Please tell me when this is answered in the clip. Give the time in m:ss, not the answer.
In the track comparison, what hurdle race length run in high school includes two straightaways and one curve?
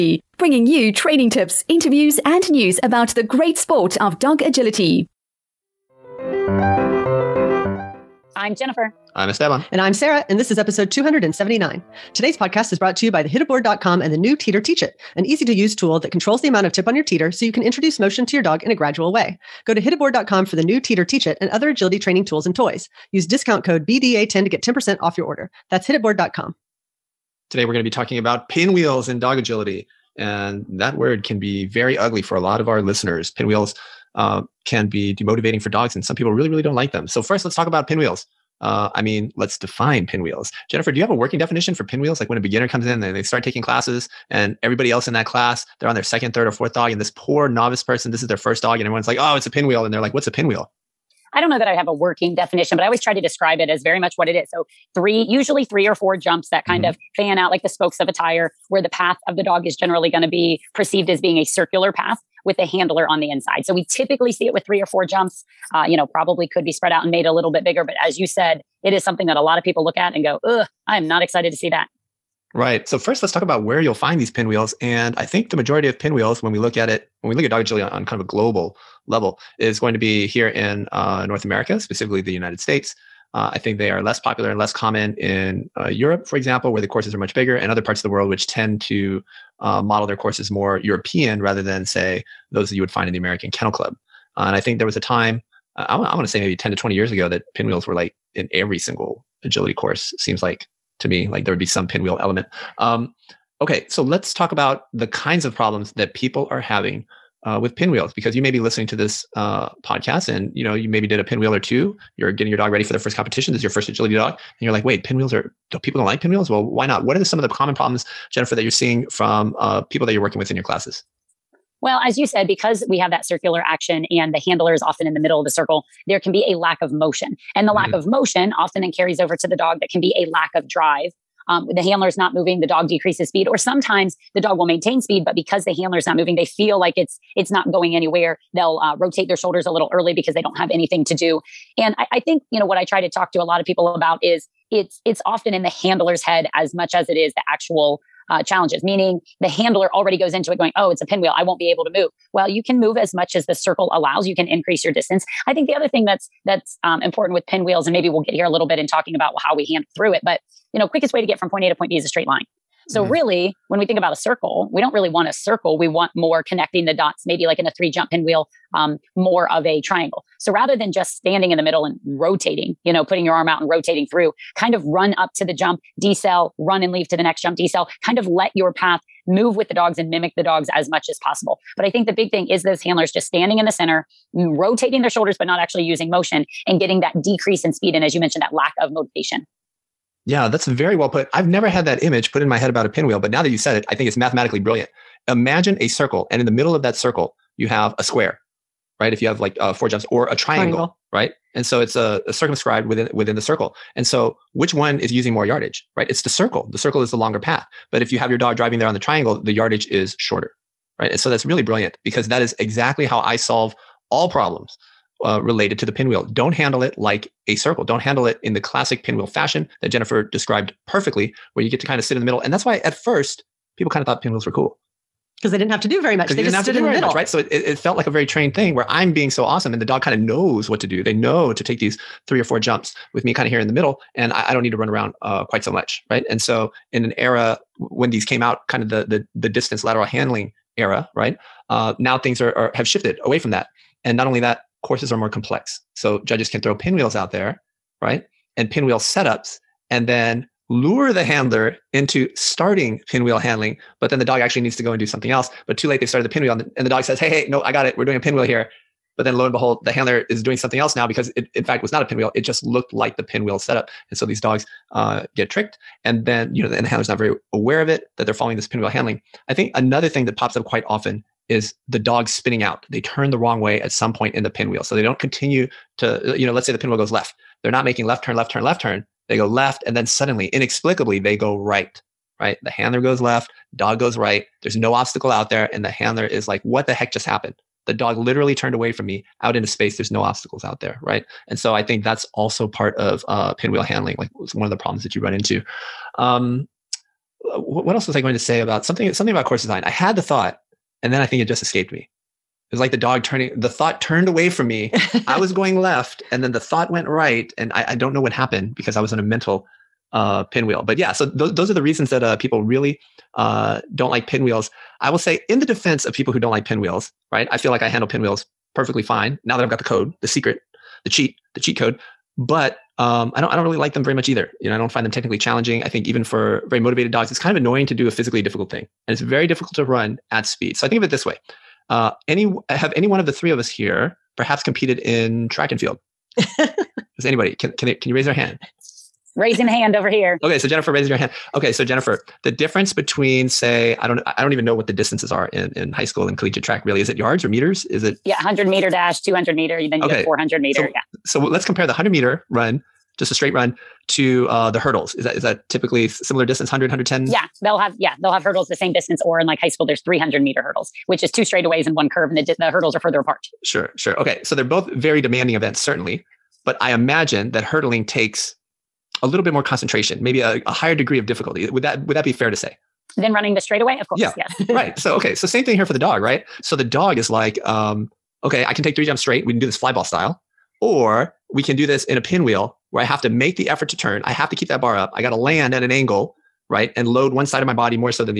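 6:00.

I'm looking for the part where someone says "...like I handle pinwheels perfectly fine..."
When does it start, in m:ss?
5:17.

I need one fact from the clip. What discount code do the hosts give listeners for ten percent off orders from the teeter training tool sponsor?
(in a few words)
BDA10.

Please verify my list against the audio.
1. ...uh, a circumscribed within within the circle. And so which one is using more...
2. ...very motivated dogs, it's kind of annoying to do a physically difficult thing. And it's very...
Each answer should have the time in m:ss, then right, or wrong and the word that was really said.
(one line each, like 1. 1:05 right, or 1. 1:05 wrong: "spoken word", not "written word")
1. 3:21 right
2. 5:26 right.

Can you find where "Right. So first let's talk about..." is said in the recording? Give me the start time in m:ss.
1:12.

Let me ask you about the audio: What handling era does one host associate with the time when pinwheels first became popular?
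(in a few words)
distance lateral handling era.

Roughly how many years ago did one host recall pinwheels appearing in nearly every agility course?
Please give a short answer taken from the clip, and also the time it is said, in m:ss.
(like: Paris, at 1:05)
10 to 20 years, at 1:36.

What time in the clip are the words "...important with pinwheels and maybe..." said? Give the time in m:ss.
2:37.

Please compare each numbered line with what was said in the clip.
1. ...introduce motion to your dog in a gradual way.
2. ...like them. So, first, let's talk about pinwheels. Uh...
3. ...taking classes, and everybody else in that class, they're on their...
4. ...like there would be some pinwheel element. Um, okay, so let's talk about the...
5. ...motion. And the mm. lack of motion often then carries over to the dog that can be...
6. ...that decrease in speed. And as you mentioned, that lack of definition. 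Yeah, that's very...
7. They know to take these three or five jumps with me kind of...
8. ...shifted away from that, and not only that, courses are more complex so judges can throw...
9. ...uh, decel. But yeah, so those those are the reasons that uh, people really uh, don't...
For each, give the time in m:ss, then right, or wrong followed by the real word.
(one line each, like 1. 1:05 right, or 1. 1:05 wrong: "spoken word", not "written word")
1. 0:17 right
2. 0:36 right
3. 0:43 right
4. 1:41 right
5. 2:06 right
6. 3:07 wrong: "motivation", not "definition"
7. 3:51 wrong: "four", not "five"
8. 4:02 right
9. 5:10 wrong: "pinwheel", not "decel".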